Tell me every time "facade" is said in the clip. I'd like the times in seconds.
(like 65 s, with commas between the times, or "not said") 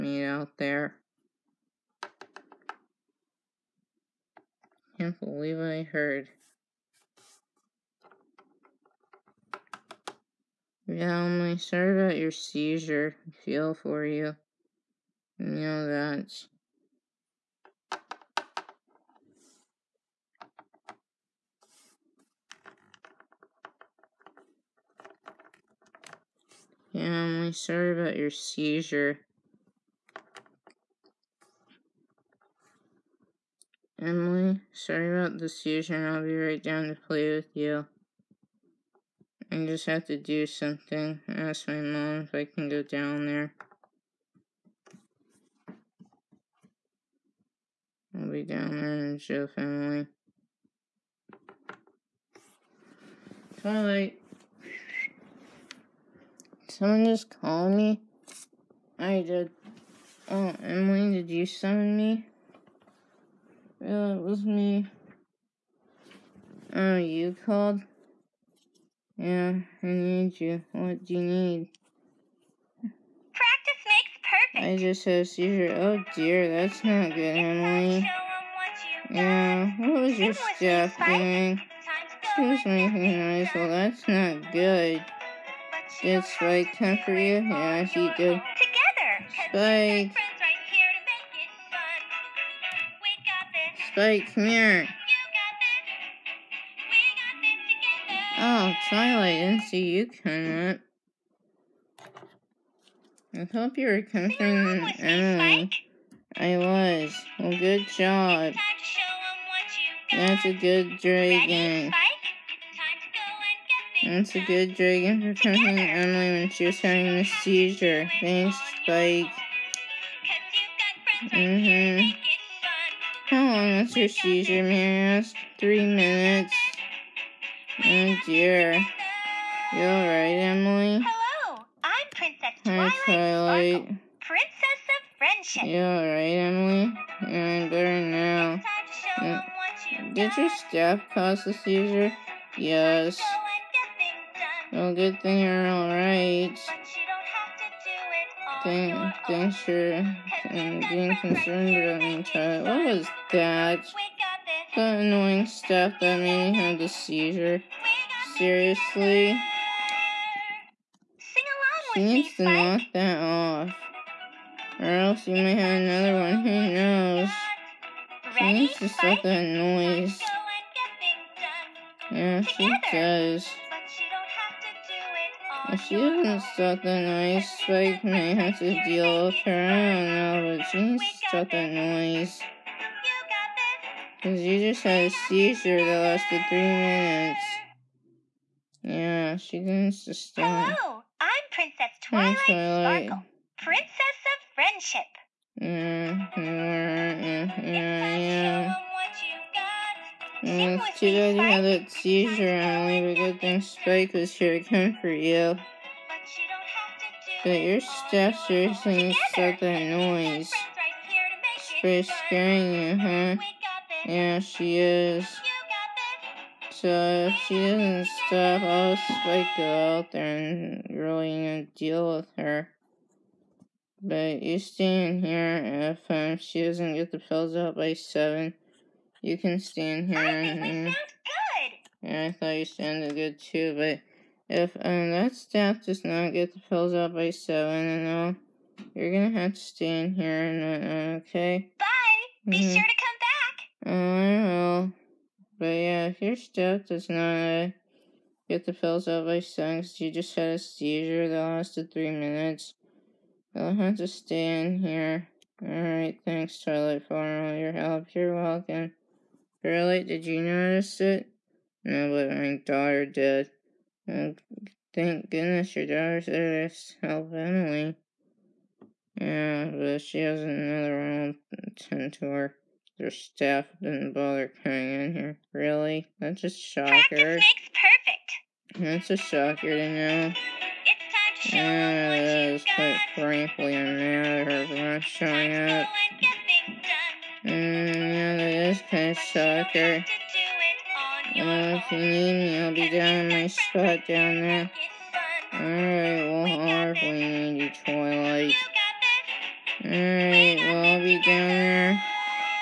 not said.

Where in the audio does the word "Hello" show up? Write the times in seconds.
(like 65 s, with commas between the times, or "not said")
131 s, 190 s.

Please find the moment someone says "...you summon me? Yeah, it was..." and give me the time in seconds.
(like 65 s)
61 s.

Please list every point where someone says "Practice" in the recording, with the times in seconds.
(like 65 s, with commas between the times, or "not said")
72 s, 277 s.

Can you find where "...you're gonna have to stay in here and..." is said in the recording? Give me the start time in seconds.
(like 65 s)
238 s.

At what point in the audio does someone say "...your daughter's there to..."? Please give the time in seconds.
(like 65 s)
265 s.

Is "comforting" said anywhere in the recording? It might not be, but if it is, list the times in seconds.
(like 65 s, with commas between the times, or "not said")
104 s, 115 s.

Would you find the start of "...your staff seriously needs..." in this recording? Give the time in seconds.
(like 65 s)
207 s.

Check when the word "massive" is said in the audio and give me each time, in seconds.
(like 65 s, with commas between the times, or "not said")
not said.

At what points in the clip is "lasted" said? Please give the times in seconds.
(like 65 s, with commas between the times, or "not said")
186 s, 251 s.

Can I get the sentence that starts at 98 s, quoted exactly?
Oh, Twilight, didn't see you coming up.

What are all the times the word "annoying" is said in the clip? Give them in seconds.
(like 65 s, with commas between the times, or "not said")
154 s.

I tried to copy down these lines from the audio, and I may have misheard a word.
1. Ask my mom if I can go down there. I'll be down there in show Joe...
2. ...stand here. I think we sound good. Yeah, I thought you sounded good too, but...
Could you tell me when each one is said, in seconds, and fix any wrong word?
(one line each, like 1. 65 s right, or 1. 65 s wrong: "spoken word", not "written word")
1. 41 s right
2. 229 s right.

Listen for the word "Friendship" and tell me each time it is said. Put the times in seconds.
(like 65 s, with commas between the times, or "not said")
135 s, 194 s.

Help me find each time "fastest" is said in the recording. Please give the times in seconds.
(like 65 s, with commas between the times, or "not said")
not said.